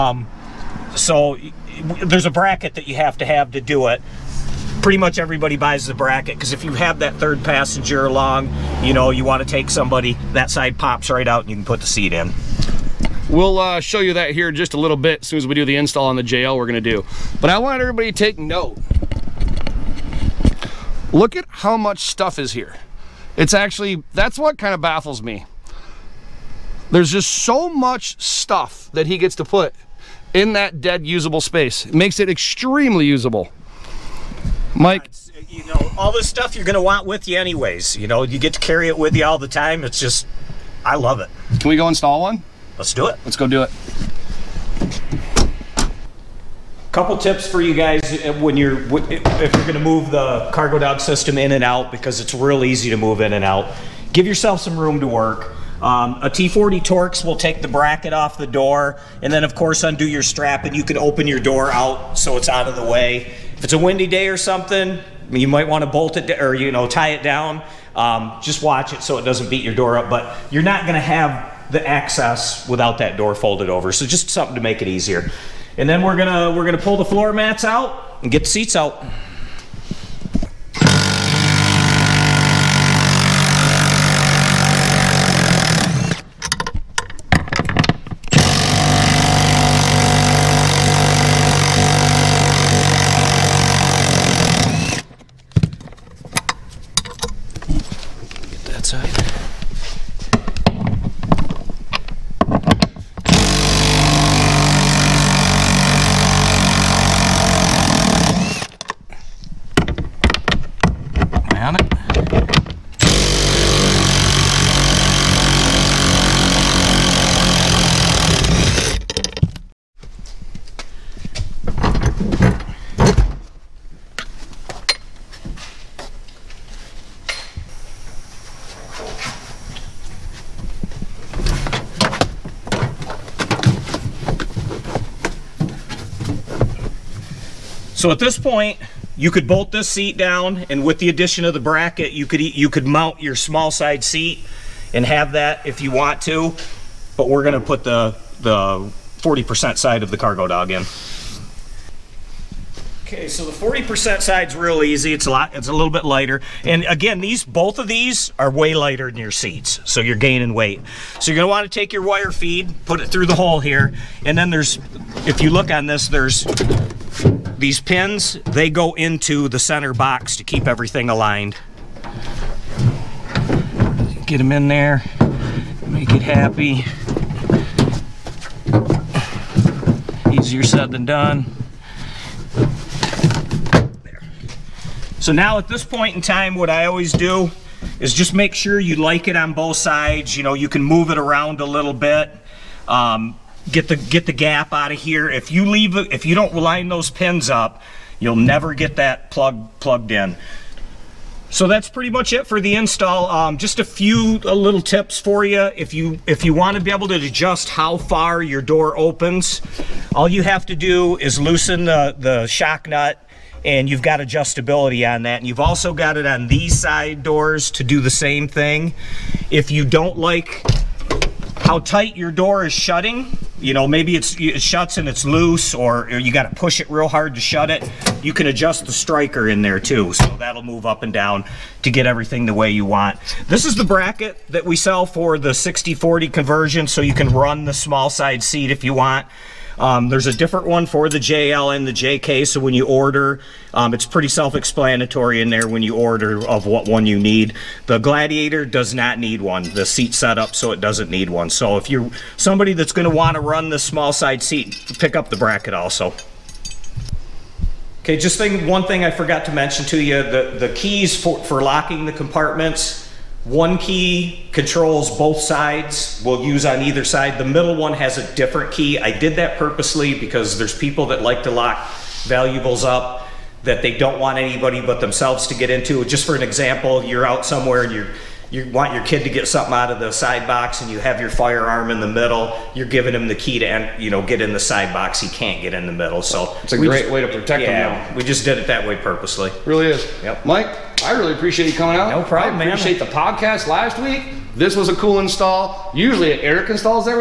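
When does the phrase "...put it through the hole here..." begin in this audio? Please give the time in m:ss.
2:42.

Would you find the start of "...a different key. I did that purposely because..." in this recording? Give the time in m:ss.
4:28.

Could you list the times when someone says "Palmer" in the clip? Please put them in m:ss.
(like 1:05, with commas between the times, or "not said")
not said.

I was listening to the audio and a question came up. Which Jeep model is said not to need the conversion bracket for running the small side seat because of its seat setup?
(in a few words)
Gladiator.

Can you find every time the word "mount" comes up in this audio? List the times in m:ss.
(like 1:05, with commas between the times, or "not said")
2:22.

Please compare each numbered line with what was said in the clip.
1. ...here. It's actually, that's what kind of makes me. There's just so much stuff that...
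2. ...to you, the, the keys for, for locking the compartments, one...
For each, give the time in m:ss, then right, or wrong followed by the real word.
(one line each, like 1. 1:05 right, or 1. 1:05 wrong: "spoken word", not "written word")
1. 0:22 wrong: "baffles", not "makes"
2. 4:19 right.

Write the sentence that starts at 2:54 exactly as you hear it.
Get them in there, make it happy.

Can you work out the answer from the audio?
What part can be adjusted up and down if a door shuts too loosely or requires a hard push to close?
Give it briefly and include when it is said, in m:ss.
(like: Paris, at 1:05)
The striker, at 3:48.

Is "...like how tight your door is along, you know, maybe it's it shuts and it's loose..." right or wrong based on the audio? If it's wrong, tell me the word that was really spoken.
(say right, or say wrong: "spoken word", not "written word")
wrong: "shutting", not "along".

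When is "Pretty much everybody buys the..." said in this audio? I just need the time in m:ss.
0:04.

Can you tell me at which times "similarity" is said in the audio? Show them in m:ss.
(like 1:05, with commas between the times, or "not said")
not said.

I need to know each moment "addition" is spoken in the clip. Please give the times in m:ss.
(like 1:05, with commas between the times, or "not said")
2:21.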